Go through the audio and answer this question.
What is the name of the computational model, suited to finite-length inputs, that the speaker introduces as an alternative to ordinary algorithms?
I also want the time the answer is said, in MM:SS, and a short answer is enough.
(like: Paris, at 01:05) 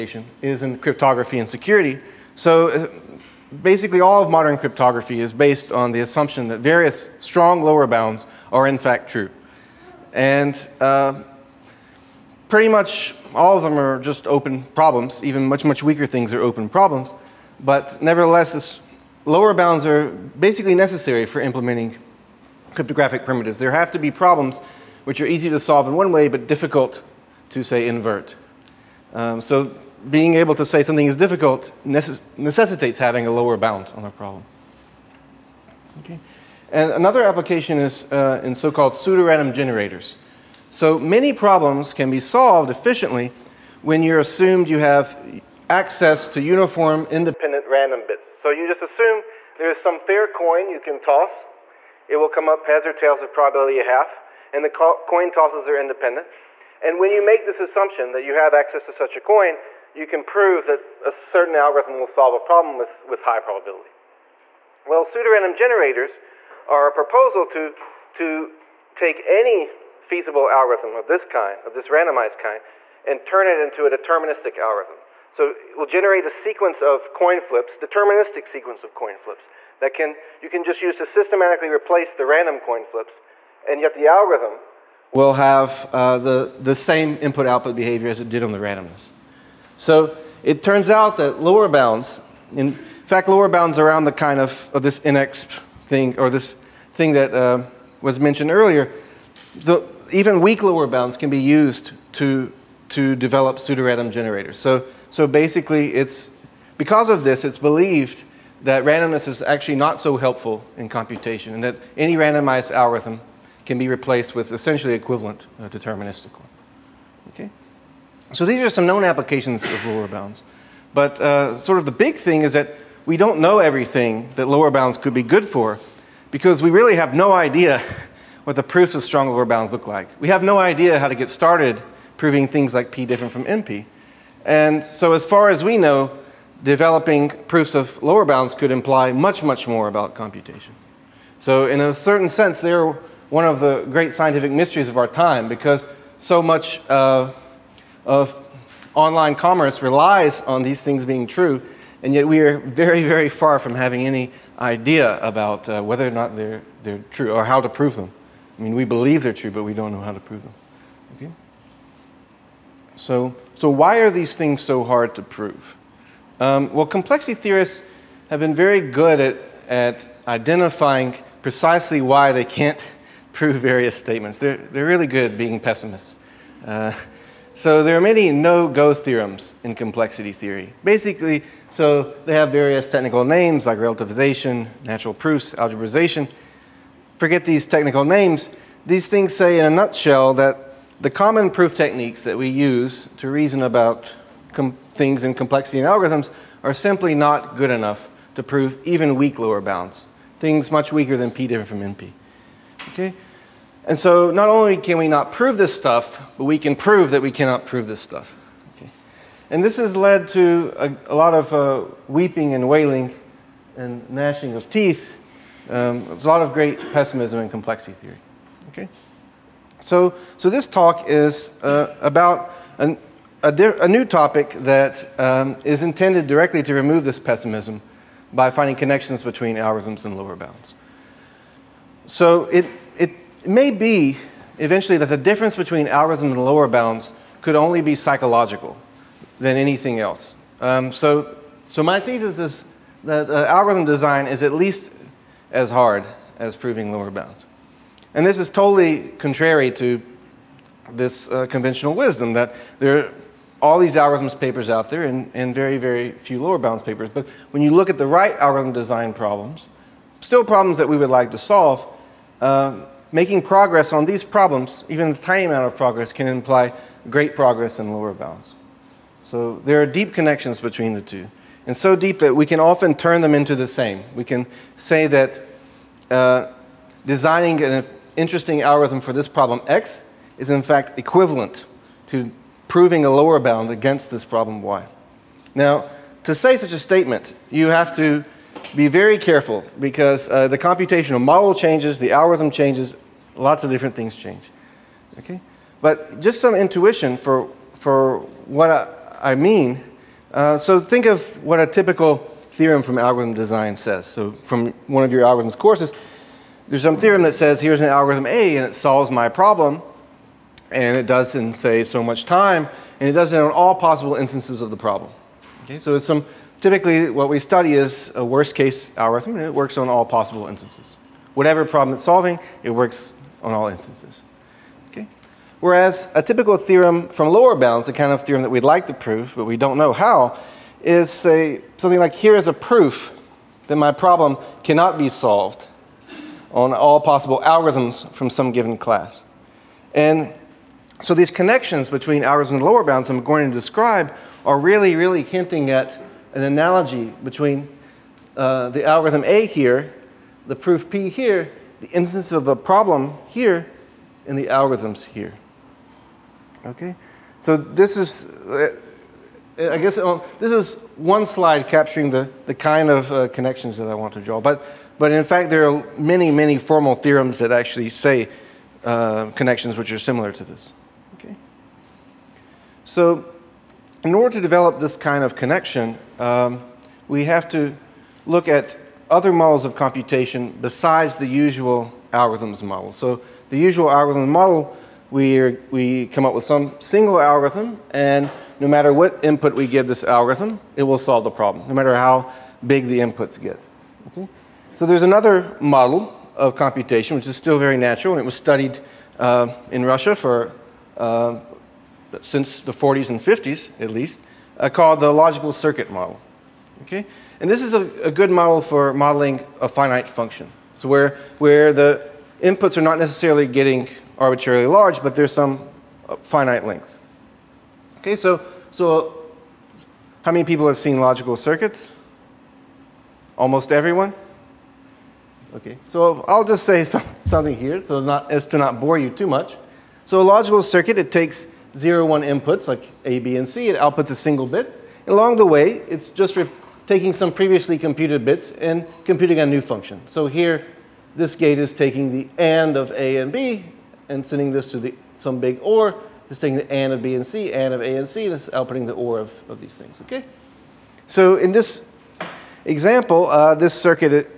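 logical circuit model, at 06:45.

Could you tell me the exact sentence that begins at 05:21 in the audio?
Whatever problem it's solving, it works on all instances.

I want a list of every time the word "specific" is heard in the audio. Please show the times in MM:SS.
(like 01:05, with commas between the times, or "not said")
not said.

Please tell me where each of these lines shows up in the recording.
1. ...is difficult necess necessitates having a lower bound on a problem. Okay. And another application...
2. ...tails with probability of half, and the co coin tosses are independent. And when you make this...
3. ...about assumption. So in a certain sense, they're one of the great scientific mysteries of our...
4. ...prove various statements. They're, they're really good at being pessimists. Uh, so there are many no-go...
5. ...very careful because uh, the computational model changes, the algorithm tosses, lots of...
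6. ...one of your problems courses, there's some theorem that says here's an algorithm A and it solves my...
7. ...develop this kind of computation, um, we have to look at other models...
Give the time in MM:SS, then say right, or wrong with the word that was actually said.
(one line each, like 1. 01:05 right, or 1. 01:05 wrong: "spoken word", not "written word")
1. 00:31 right
2. 00:52 right
3. 02:19 wrong: "computation", not "assumption"
4. 02:53 right
5. 04:48 wrong: "changes", not "tosses"
6. 05:04 wrong: "algorithms", not "problems"
7. 06:14 wrong: "connection", not "computation".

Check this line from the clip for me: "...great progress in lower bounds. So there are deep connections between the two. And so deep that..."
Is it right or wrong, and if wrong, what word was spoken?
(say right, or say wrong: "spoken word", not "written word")
right.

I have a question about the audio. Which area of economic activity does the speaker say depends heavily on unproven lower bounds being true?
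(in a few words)
online commerce.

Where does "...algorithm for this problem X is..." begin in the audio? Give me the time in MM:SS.
04:38.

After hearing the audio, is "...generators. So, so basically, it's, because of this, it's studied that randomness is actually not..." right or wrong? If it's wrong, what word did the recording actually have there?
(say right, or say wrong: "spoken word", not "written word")
wrong: "believed", not "studied".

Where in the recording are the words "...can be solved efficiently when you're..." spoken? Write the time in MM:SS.
00:41.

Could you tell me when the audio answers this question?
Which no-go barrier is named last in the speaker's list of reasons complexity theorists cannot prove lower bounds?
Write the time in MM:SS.
03:05.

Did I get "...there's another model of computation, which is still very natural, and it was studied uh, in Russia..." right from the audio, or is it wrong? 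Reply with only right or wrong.
right.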